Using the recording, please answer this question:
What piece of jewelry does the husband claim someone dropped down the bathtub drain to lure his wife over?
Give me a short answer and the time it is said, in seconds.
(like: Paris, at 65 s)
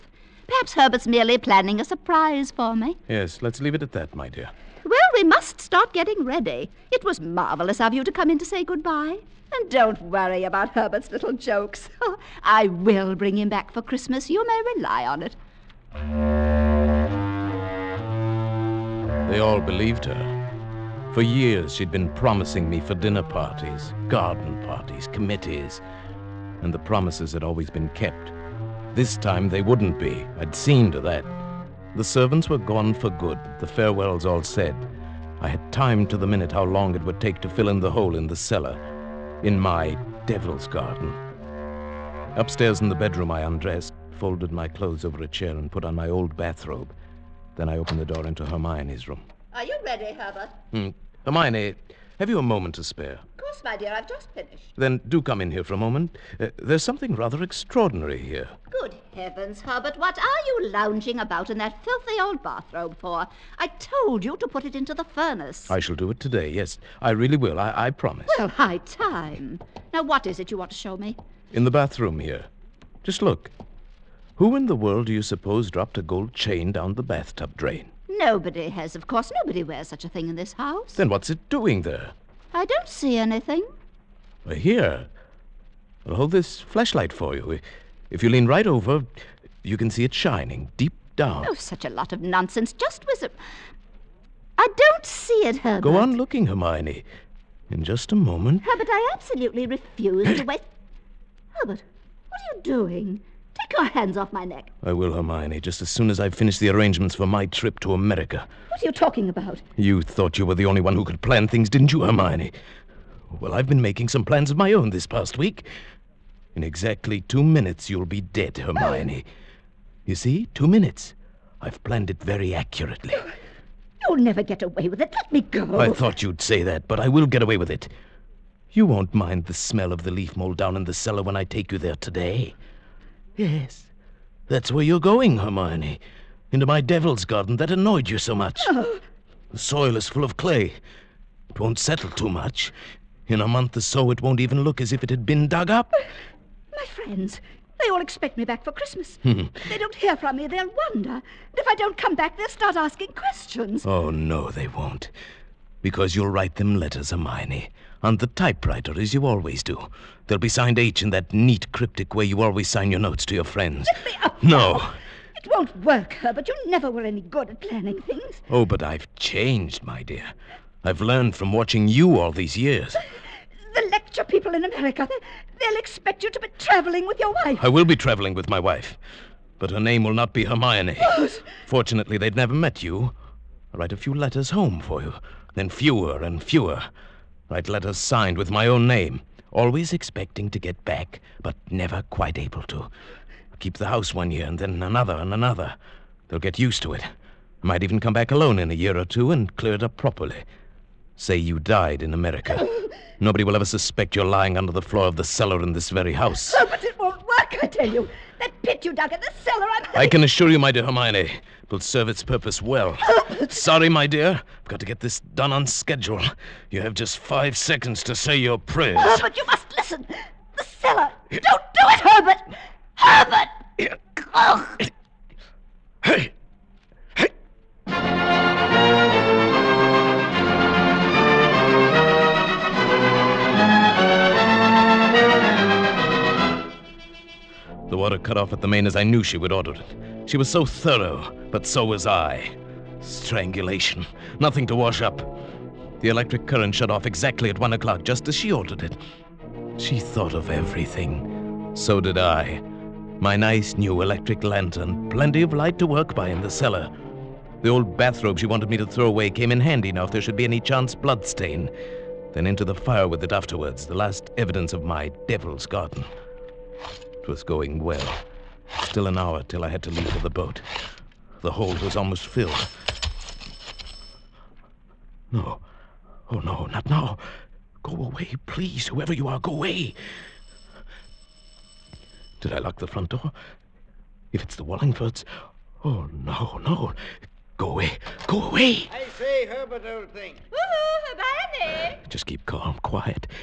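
Gold chain, at 76 s.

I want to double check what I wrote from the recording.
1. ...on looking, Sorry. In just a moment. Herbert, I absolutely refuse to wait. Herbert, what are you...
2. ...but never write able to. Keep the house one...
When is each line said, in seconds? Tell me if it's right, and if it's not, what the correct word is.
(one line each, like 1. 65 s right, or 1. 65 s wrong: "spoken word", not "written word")
1. 95 s wrong: "Hermione", not "Sorry"
2. 191 s wrong: "quite", not "write".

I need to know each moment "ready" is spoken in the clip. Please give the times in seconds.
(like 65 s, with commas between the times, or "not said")
6 s, 49 s.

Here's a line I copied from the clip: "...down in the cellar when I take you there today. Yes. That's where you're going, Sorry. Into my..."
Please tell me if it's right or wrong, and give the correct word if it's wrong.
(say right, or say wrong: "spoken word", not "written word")
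wrong: "Hermione", not "Sorry".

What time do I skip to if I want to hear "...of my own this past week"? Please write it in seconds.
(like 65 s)
114 s.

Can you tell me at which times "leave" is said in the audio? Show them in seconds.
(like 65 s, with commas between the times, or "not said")
3 s, 269 s.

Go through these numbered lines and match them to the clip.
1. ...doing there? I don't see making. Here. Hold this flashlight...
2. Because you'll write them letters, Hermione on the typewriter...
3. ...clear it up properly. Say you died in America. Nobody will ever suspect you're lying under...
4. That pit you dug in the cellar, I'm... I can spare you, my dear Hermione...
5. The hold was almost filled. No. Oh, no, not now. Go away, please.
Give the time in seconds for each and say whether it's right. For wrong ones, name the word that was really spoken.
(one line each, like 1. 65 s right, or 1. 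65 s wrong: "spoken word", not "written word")
1. 81 s wrong: "anything", not "making"
2. 155 s right
3. 199 s right
4. 208 s wrong: "assure", not "spare"
5. 271 s right.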